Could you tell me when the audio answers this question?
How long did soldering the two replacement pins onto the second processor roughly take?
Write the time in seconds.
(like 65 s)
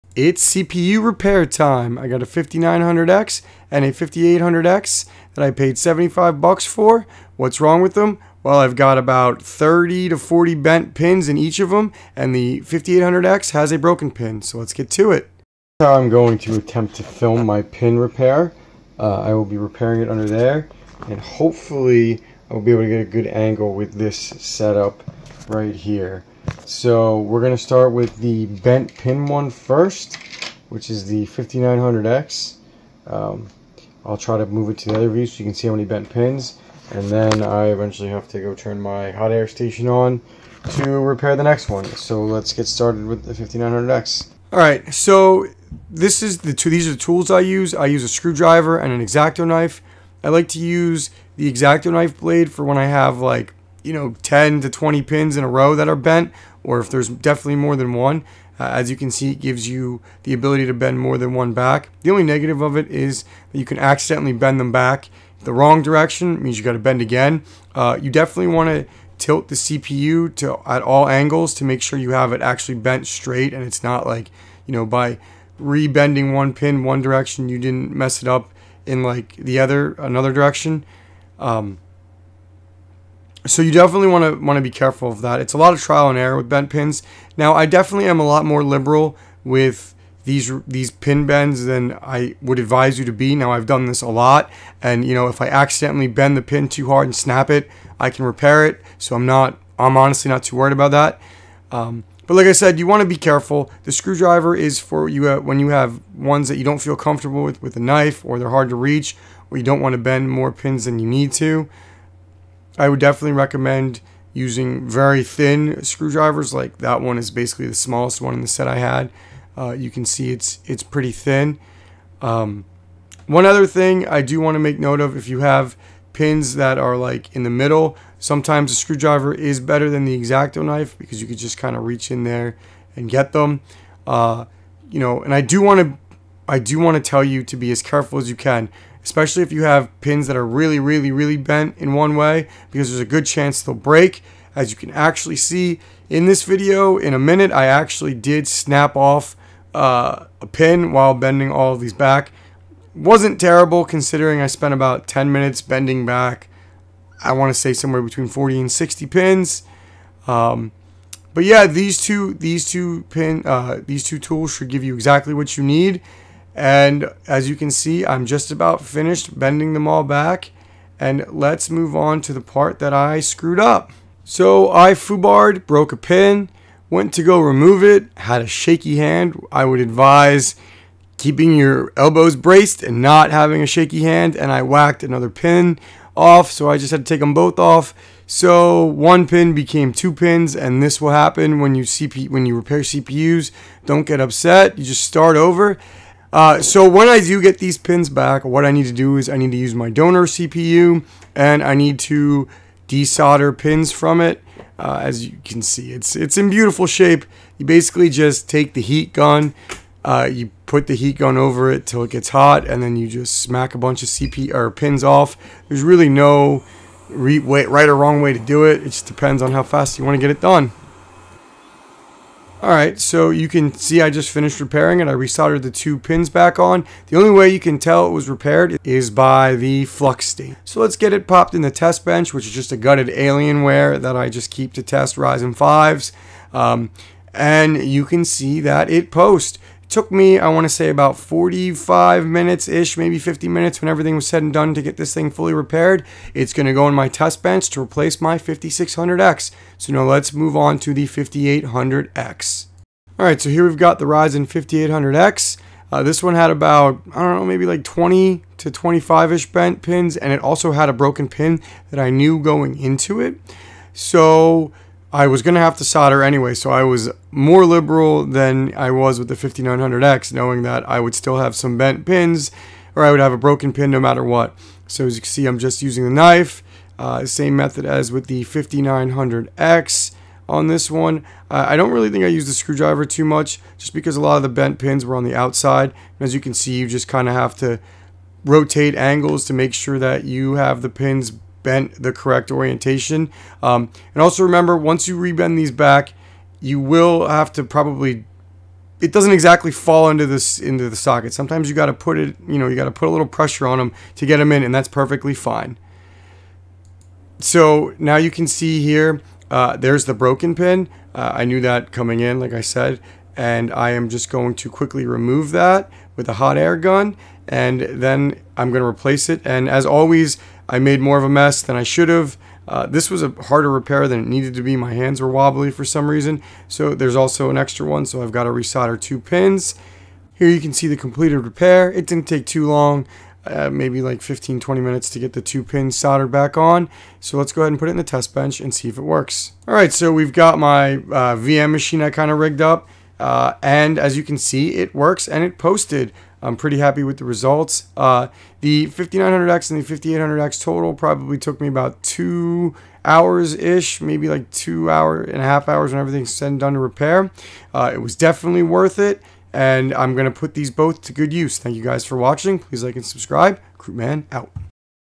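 334 s.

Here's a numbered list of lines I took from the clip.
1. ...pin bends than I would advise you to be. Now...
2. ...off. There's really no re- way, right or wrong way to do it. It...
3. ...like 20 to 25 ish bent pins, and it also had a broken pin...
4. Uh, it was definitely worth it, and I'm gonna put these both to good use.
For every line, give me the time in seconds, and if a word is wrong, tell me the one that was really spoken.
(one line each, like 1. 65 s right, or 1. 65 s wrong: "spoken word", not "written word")
1. 90 s right
2. 215 s right
3. 257 s right
4. 357 s right.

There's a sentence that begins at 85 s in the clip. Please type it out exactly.
It's a lot of trial and error with bent pins.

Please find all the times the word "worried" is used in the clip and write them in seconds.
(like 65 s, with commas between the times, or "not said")
100 s.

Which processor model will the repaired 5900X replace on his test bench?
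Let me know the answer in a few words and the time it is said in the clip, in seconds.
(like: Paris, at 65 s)
5600X, at 248 s.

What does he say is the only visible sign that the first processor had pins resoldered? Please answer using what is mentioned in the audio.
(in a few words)
The flux.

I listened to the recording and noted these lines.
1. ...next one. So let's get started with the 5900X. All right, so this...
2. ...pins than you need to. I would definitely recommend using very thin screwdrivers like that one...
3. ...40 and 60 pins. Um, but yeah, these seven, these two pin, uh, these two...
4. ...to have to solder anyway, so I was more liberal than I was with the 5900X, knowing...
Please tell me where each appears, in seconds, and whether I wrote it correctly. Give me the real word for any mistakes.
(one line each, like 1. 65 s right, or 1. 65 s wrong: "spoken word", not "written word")
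1. 41 s right
2. 110 s right
3. 158 s wrong: "two", not "seven"
4. 265 s right.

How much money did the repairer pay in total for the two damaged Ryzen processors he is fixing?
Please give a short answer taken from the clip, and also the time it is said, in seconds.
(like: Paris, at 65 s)
$75, at 5 s.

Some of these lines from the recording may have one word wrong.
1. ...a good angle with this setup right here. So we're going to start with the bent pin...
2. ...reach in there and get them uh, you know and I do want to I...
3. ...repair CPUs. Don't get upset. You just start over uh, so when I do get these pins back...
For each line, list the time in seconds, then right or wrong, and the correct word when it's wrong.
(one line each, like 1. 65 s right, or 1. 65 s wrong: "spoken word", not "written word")
1. 23 s right
2. 131 s right
3. 192 s right.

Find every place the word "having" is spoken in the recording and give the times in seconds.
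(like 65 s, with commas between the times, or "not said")
183 s.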